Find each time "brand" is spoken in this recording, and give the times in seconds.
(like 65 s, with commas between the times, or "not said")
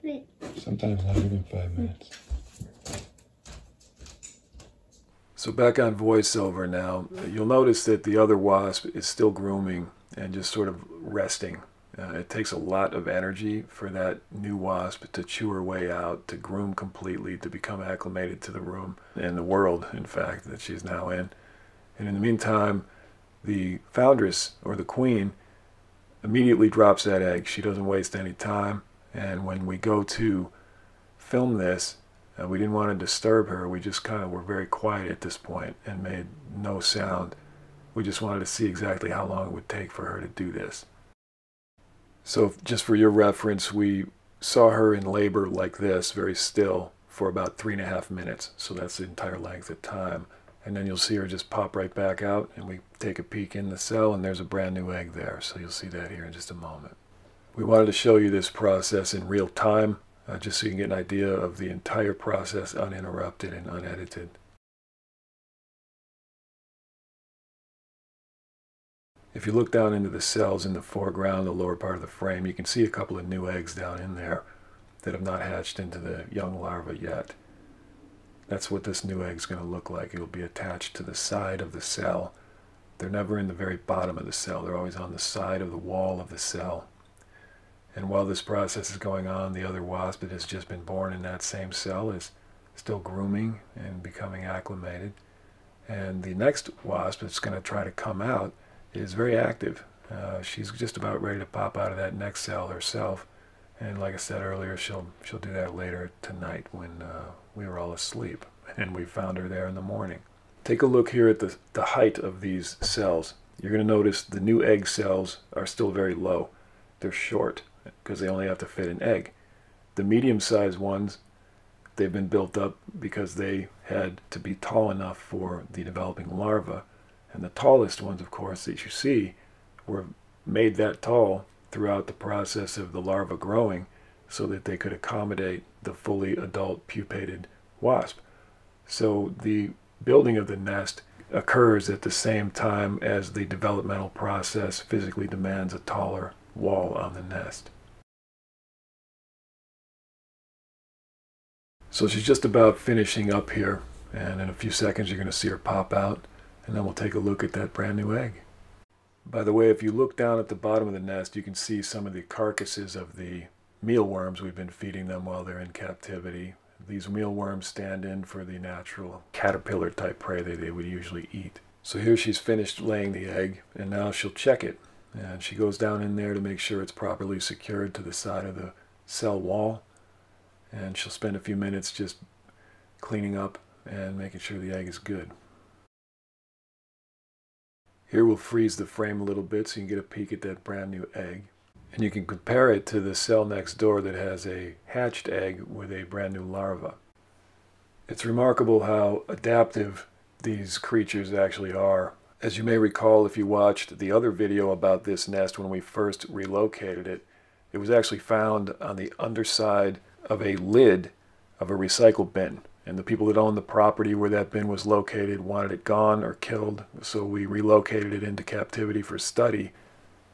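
54 s, 157 s, 190 s, 196 s.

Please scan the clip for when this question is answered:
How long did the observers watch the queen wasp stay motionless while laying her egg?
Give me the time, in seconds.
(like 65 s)
47 s.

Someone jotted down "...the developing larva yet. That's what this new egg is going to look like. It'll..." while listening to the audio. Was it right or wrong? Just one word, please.
wrong.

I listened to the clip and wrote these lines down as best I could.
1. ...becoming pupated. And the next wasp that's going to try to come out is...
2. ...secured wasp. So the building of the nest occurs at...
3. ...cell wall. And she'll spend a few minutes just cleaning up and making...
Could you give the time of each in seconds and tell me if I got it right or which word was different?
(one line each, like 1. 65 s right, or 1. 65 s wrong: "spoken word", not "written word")
1. 94 s wrong: "acclimated", not "pupated"
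2. 136 s wrong: "pupated", not "secured"
3. 179 s right.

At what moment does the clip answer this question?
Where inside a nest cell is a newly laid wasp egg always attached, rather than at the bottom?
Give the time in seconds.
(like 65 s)
84 s.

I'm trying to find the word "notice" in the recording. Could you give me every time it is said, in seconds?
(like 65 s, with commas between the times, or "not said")
7 s, 113 s.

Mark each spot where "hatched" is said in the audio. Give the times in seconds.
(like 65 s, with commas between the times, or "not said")
75 s, 194 s.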